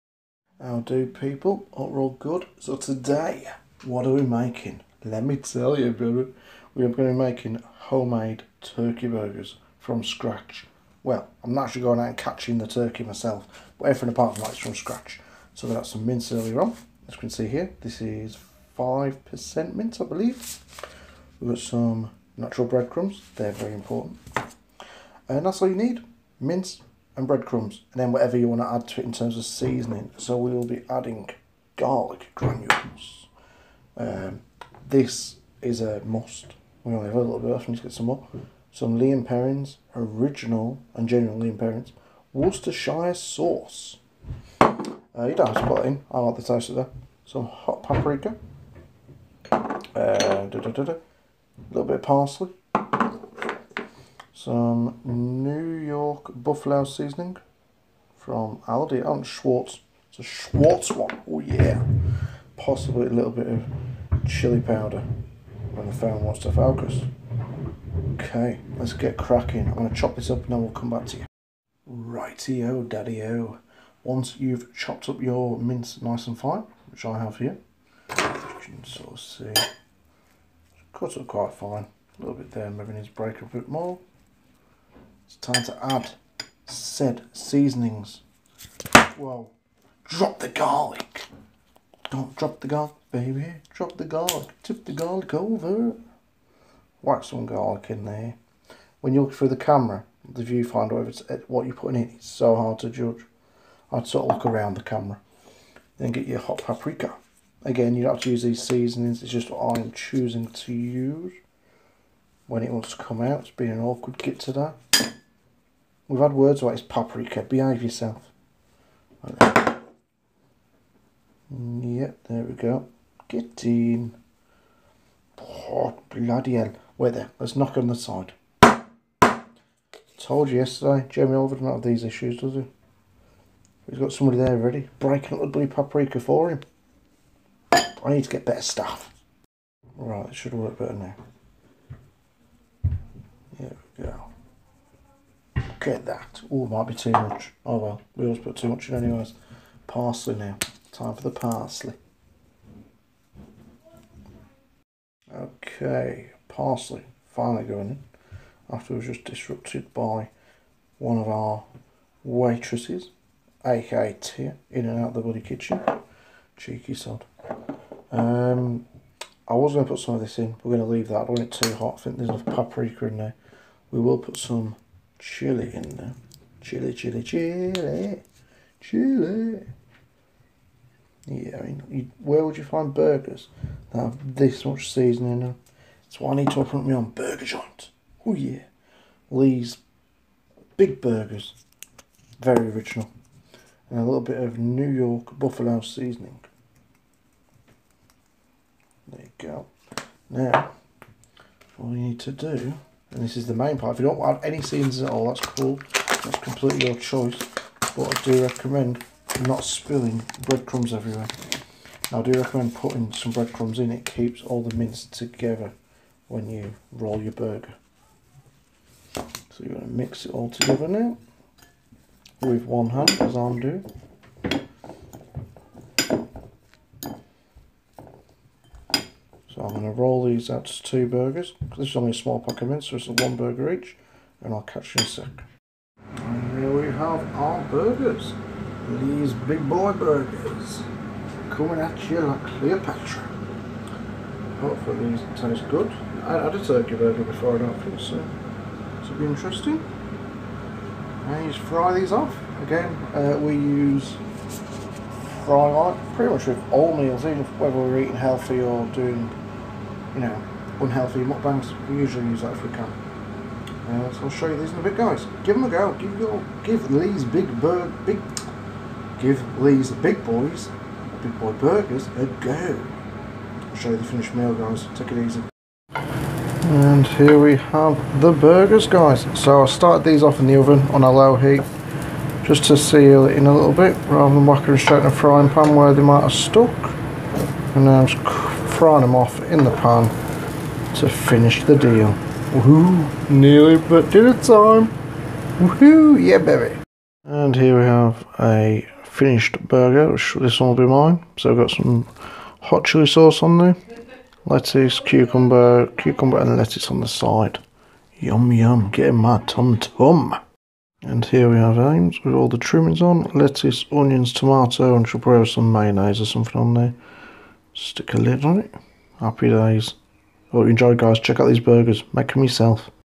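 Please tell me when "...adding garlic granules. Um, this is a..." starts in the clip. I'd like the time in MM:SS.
00:30.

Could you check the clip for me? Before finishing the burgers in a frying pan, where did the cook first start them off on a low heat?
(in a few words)
the oven.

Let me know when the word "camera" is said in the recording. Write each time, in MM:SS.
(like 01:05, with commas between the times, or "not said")
01:39, 01:44.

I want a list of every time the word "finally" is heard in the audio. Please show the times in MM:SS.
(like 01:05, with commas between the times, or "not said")
02:37.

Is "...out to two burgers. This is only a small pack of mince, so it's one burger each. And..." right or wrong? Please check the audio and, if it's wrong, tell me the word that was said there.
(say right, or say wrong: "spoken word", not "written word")
right.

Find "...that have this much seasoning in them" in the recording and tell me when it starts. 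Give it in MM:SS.
03:03.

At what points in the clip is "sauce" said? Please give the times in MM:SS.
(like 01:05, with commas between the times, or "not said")
00:43, 05:03.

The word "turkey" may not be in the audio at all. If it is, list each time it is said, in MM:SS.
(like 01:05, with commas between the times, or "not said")
00:08, 00:12, 04:06.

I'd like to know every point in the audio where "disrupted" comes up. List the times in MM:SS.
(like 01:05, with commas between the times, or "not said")
02:39.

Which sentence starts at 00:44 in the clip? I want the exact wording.
Uh, you don't have to put it in, I like the taste of that.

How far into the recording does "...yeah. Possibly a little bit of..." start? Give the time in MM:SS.
01:01.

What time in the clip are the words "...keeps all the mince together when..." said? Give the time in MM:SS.
03:34.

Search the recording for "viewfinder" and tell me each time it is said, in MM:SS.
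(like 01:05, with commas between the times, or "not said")
01:40.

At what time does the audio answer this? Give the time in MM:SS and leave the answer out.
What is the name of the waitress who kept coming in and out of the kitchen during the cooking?
02:44.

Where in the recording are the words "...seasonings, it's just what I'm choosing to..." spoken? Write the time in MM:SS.
01:48.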